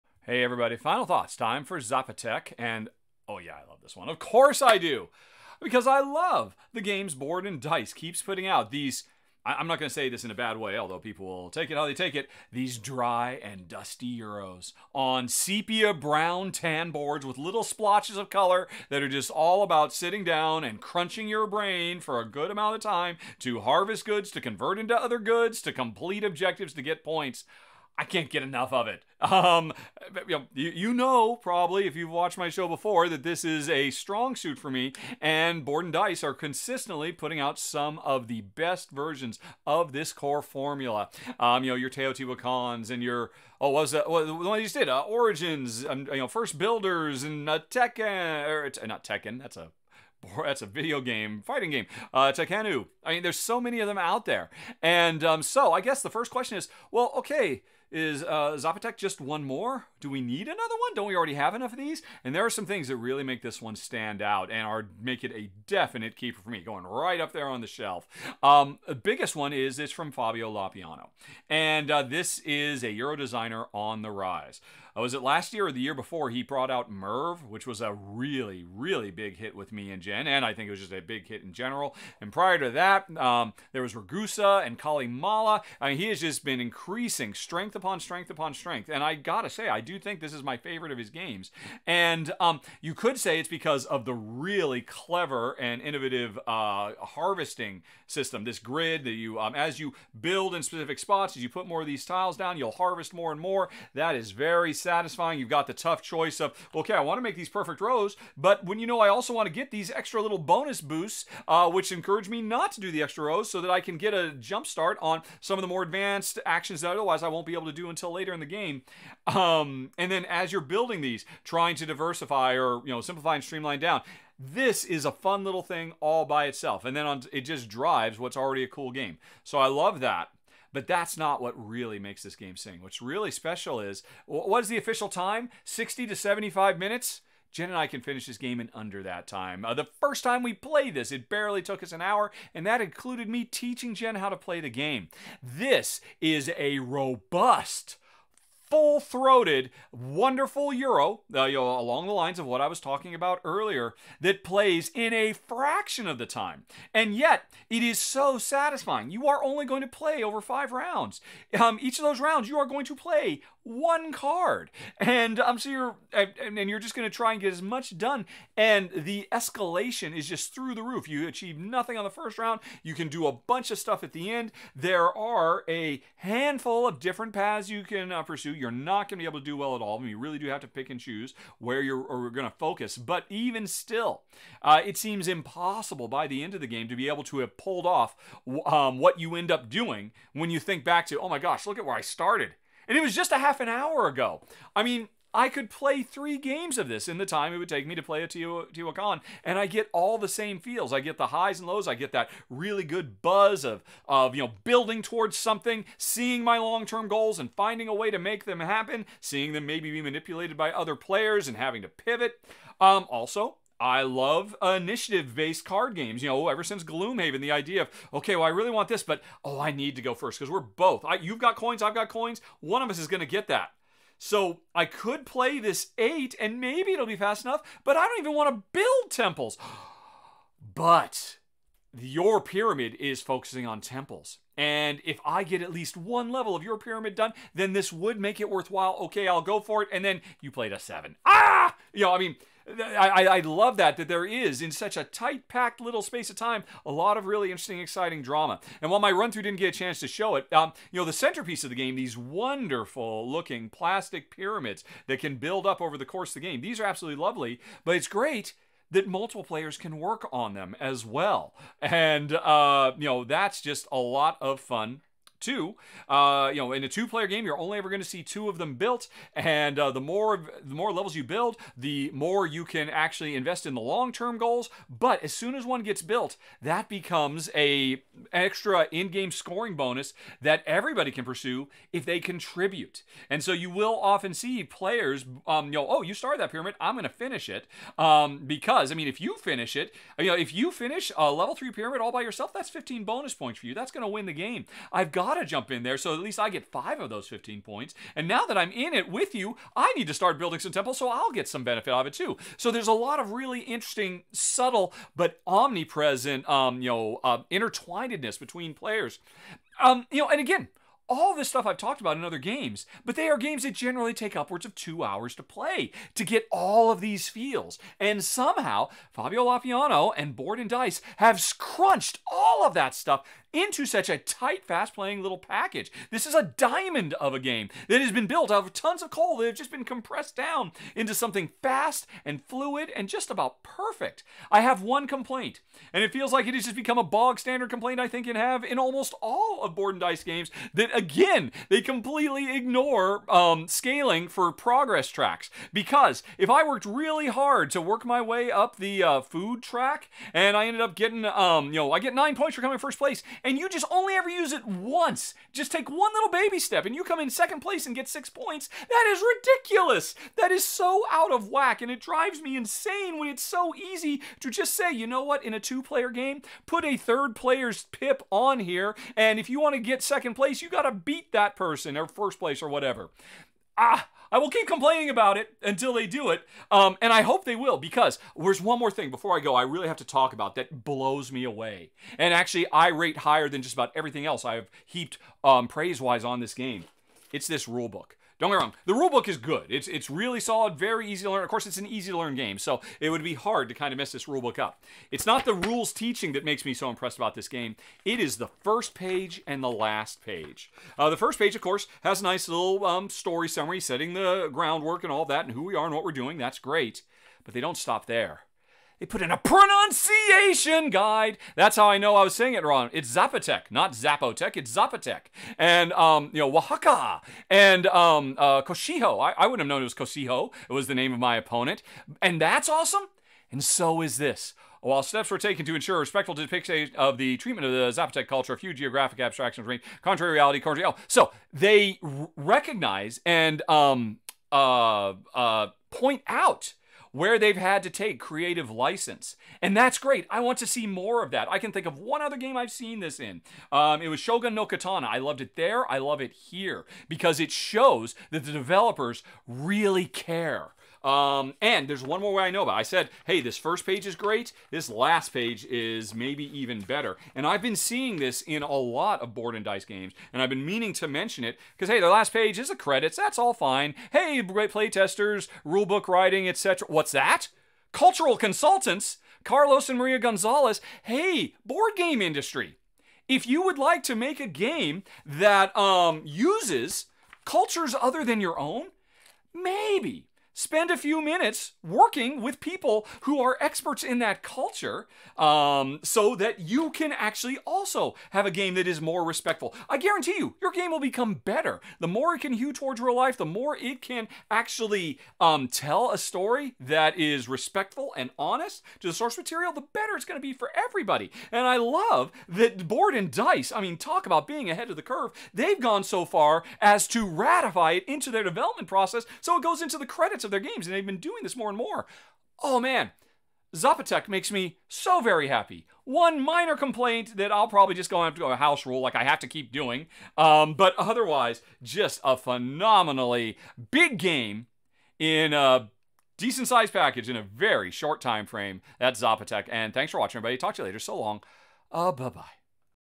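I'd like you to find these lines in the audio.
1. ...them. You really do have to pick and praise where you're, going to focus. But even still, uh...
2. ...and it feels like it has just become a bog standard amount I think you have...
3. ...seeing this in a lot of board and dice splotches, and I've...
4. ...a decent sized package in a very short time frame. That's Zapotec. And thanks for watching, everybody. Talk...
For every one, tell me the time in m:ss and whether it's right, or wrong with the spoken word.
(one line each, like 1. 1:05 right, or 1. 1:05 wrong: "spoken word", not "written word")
1. 3:00 wrong: "choose", not "praise"
2. 5:35 wrong: "complaint", not "amount"
3. 7:37 wrong: "games", not "splotches"
4. 8:45 right.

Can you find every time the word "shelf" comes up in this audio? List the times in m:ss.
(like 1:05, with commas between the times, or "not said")
1:07.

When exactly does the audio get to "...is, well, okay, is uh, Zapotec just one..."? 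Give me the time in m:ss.
0:56.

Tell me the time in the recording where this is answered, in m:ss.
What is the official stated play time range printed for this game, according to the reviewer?
2:15.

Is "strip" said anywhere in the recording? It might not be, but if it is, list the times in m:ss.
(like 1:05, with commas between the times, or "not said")
not said.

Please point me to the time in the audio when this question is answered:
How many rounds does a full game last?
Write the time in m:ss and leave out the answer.
2:40.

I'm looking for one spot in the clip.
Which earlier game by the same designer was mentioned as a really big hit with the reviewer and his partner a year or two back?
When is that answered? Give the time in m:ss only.
1:16.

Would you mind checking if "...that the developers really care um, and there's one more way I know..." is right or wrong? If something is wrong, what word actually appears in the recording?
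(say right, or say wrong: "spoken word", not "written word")
right.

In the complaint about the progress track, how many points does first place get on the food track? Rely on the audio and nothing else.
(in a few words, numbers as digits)
9.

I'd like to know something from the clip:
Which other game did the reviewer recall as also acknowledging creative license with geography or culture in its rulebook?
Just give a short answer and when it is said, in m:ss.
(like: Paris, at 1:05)
Shogun no Katana, at 7:24.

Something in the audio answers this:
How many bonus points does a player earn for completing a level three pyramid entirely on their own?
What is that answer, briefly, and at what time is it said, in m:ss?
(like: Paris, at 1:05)
15, at 4:52.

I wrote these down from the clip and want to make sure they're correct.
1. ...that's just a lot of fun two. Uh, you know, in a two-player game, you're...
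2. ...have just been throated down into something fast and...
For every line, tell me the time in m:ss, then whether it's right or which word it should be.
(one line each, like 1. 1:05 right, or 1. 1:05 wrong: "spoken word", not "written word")
1. 4:23 right
2. 5:29 wrong: "compressed", not "throated".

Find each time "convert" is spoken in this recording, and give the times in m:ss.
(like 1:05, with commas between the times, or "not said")
0:24.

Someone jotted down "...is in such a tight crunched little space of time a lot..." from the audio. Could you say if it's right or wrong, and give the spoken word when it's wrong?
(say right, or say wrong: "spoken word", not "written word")
wrong: "packed", not "crunched".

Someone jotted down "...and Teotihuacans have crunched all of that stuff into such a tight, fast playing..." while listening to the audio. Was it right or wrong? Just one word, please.
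wrong.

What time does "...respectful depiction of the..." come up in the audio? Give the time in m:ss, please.
7:06.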